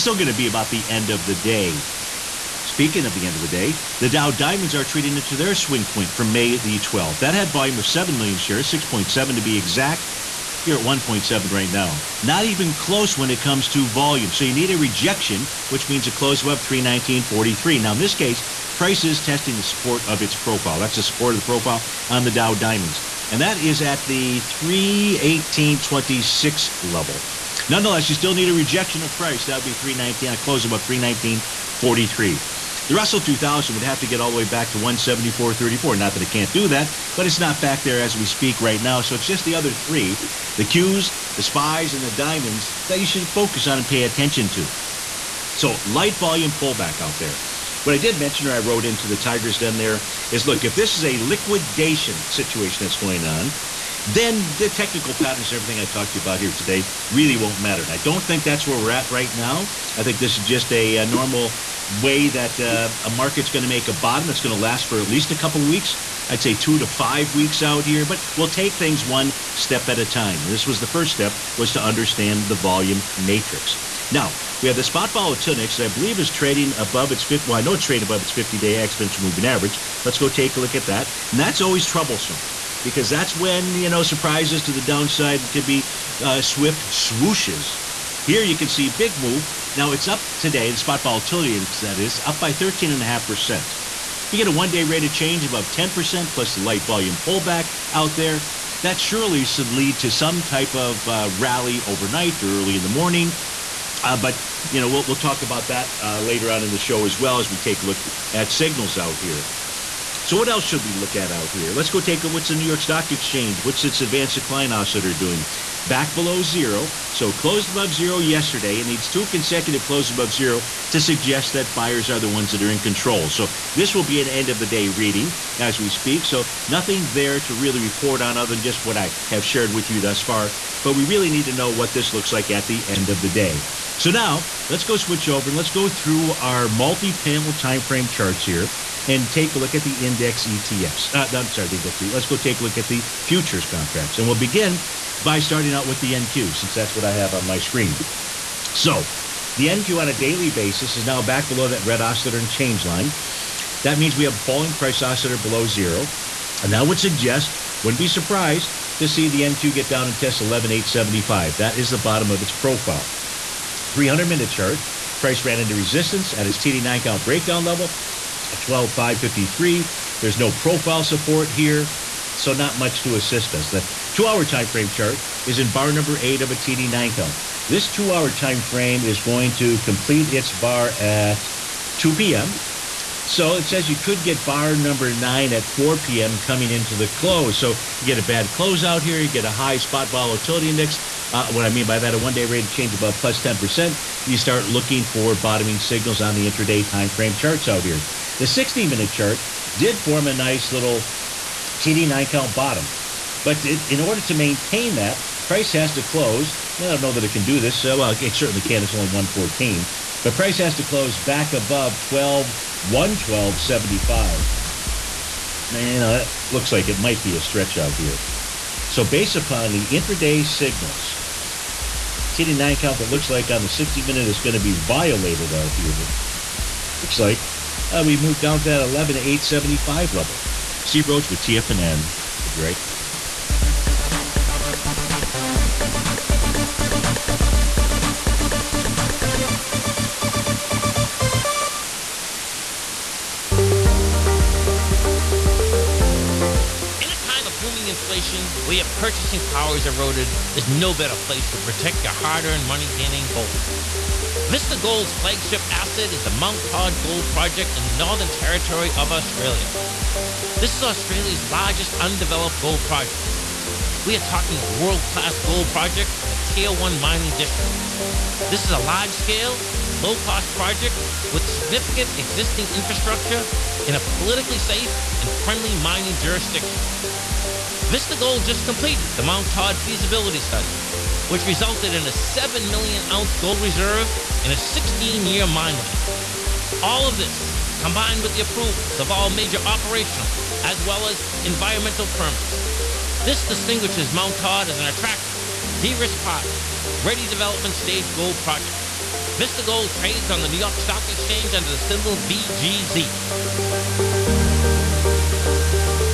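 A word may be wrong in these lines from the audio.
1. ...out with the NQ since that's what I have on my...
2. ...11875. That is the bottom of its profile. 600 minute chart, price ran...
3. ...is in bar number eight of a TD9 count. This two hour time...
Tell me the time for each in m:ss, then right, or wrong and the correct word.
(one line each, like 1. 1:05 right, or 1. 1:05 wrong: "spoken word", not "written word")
1. 2:25 right
2. 2:40 wrong: "300", not "600"
3. 2:55 right.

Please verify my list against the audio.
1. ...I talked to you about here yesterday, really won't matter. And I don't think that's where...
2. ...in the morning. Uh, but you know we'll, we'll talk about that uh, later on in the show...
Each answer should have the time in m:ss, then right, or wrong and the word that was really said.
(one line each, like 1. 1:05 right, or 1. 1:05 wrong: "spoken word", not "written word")
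1. 0:55 wrong: "today", not "yesterday"
2. 1:42 right.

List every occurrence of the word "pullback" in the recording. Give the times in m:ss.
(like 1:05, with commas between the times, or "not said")
0:46, 1:37.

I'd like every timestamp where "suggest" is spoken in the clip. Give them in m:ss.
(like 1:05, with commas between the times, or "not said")
2:00, 2:36.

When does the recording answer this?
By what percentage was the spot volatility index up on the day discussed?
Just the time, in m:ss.
1:32.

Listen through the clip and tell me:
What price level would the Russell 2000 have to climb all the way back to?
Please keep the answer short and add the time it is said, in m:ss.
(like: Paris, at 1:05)
174.34, at 0:34.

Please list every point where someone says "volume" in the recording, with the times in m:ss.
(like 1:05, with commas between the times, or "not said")
0:07, 0:13, 0:46, 1:12, 1:36.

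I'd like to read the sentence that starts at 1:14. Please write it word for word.
Now we have the spot volatility that I believe is trading above its 50.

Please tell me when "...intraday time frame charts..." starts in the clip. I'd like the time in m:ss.
3:16.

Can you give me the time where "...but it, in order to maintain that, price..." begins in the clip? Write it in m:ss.
3:23.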